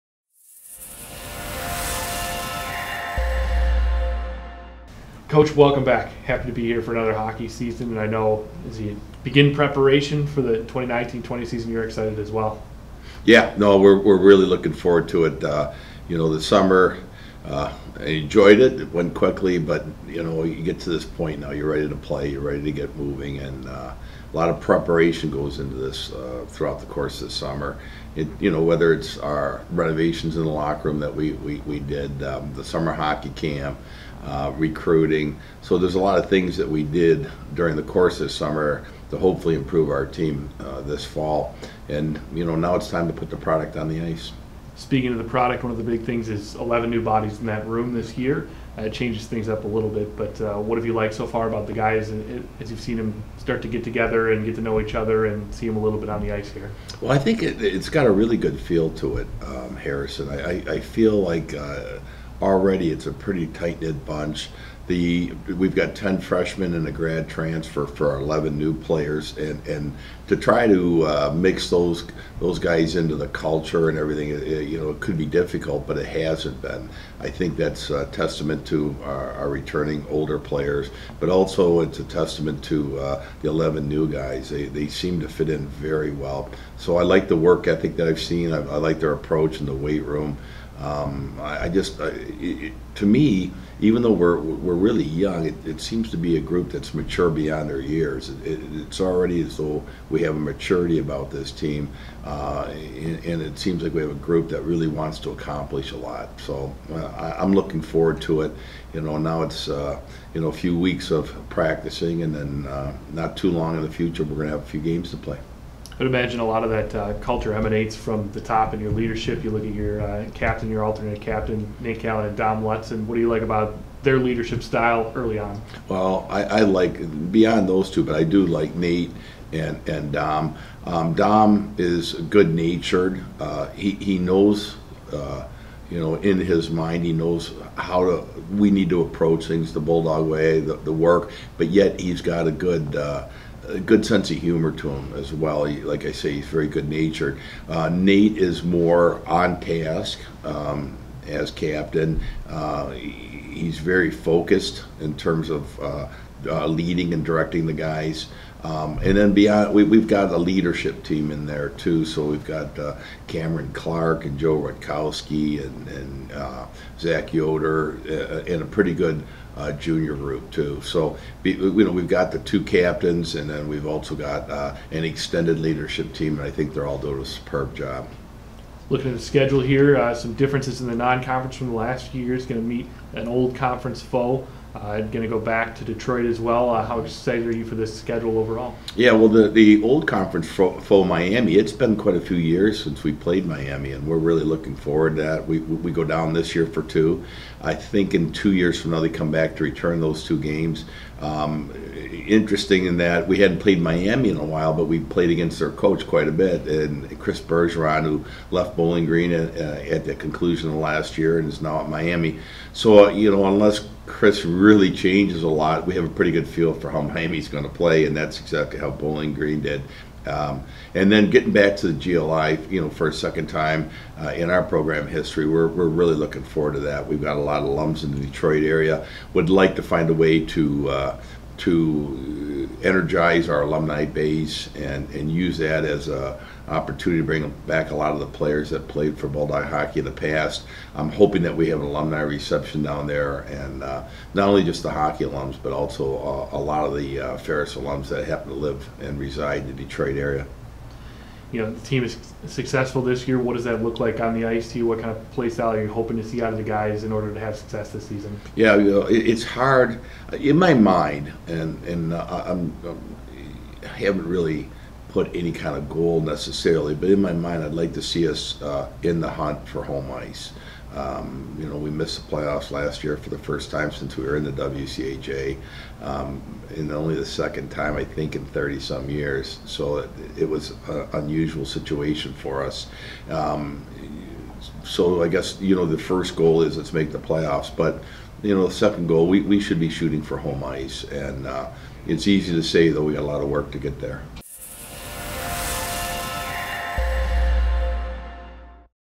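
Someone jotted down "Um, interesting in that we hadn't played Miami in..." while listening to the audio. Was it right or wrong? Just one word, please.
right.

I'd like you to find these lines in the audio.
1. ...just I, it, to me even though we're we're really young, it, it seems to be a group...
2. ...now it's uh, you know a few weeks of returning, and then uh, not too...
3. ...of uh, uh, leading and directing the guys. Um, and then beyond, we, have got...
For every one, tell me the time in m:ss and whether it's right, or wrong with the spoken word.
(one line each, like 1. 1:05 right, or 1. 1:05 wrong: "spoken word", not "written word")
1. 1:31 right
2. 1:49 wrong: "practicing", not "returning"
3. 2:35 right.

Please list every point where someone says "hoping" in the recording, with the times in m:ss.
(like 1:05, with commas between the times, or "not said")
4:01, 4:15.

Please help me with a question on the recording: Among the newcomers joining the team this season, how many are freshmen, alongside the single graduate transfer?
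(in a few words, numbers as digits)
10.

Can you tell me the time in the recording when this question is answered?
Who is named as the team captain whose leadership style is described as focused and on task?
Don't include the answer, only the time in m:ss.
2:01.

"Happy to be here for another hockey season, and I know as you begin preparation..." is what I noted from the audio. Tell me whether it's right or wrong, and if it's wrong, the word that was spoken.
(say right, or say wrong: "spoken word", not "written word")
right.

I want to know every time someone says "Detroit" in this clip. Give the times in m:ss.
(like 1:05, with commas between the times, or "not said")
3:05, 3:48, 4:09.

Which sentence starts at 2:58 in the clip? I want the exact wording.
Looking at the schedule here, some differences in the non-conference from the last few years.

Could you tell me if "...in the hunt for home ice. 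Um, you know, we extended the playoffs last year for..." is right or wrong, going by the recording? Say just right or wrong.
wrong.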